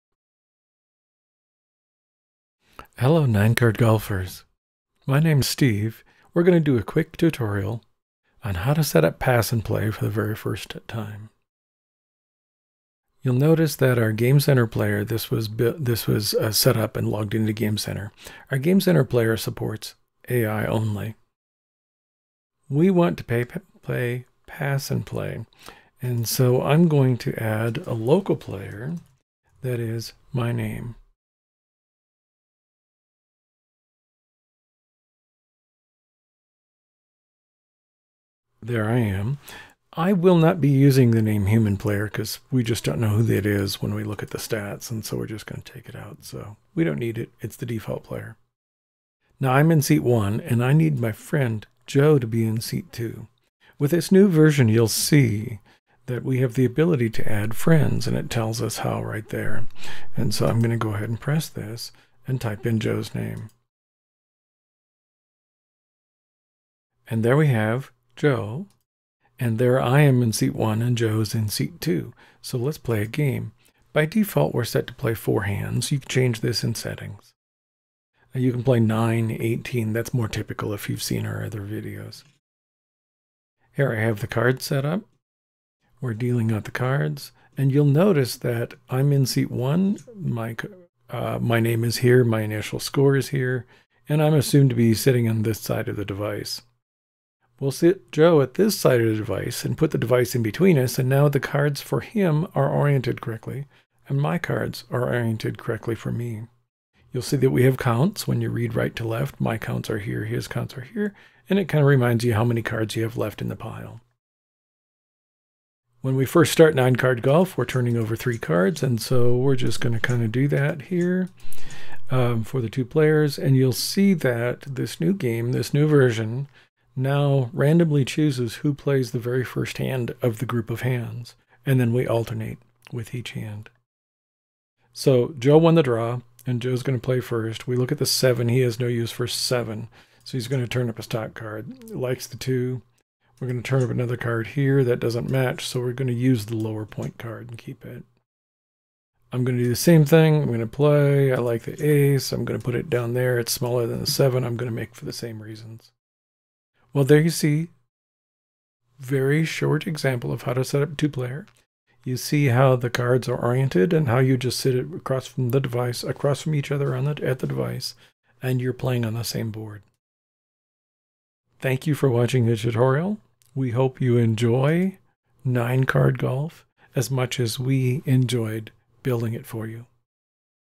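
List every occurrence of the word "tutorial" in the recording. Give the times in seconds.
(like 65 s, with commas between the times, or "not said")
7 s, 172 s.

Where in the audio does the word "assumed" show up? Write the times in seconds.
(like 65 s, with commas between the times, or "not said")
94 s.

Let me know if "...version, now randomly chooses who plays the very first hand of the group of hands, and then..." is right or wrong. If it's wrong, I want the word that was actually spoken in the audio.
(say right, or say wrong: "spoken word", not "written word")
right.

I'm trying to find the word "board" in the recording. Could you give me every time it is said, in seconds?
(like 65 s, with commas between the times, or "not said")
169 s.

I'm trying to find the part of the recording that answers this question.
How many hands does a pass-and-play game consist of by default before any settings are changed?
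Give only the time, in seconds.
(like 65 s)
75 s.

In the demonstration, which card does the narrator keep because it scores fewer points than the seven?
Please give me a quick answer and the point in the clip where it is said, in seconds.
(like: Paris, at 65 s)
Ace, at 151 s.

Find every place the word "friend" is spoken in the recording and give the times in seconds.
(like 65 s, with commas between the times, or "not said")
51 s, 57 s.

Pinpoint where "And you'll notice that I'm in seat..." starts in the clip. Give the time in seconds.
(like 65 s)
87 s.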